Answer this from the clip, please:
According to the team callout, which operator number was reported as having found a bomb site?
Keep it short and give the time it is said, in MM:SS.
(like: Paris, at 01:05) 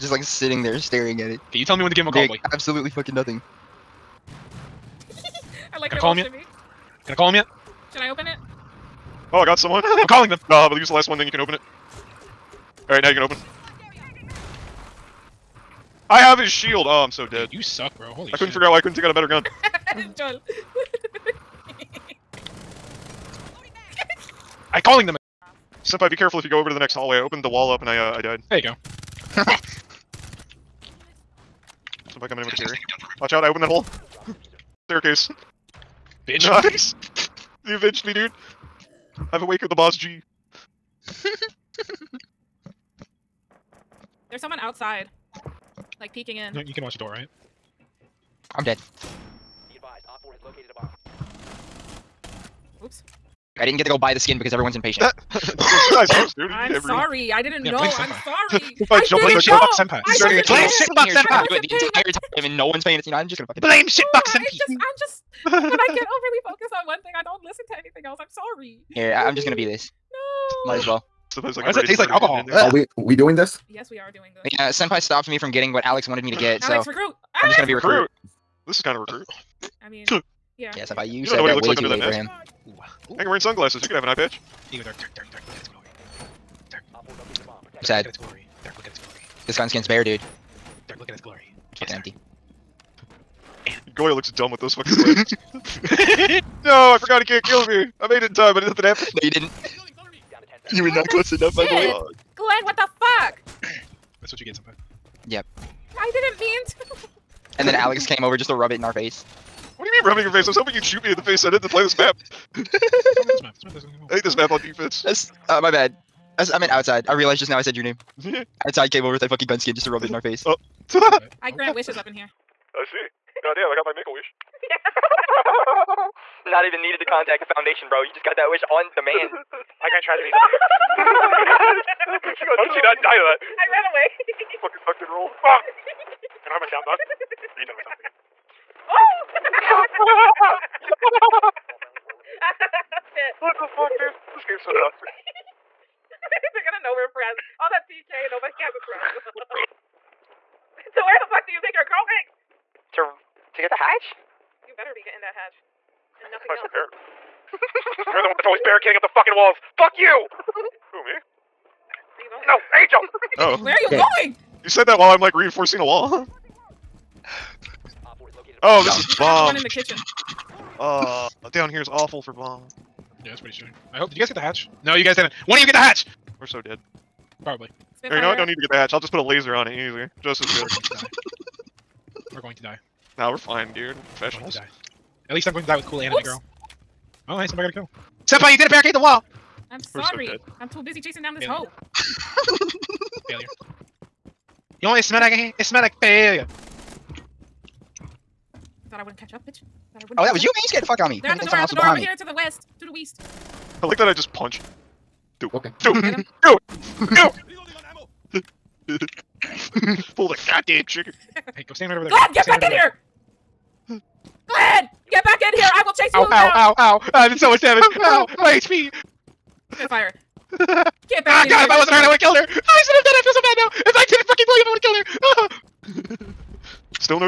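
Op 4, at 00:50.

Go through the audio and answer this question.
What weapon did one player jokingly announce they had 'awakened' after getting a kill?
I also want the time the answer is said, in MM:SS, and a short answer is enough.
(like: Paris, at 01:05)
BOSG, at 00:39.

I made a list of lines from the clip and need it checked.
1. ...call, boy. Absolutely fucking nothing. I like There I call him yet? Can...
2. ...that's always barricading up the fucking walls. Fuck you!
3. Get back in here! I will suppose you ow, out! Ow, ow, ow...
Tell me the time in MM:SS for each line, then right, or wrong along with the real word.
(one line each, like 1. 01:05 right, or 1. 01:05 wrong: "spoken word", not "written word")
1. 00:02 wrong: "Can", not "There"
2. 02:38 right
3. 03:35 wrong: "chase", not "suppose".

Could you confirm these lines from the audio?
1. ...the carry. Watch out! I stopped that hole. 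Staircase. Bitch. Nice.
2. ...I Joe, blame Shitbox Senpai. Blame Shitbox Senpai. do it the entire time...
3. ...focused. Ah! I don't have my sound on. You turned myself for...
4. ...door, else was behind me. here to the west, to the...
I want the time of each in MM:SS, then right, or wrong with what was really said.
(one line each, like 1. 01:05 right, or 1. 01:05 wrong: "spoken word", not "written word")
1. 00:32 wrong: "opened", not "stopped"
2. 00:58 right
3. 02:15 wrong: "rolled", not "focused"
4. 03:21 right.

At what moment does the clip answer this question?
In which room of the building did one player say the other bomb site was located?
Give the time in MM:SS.
02:49.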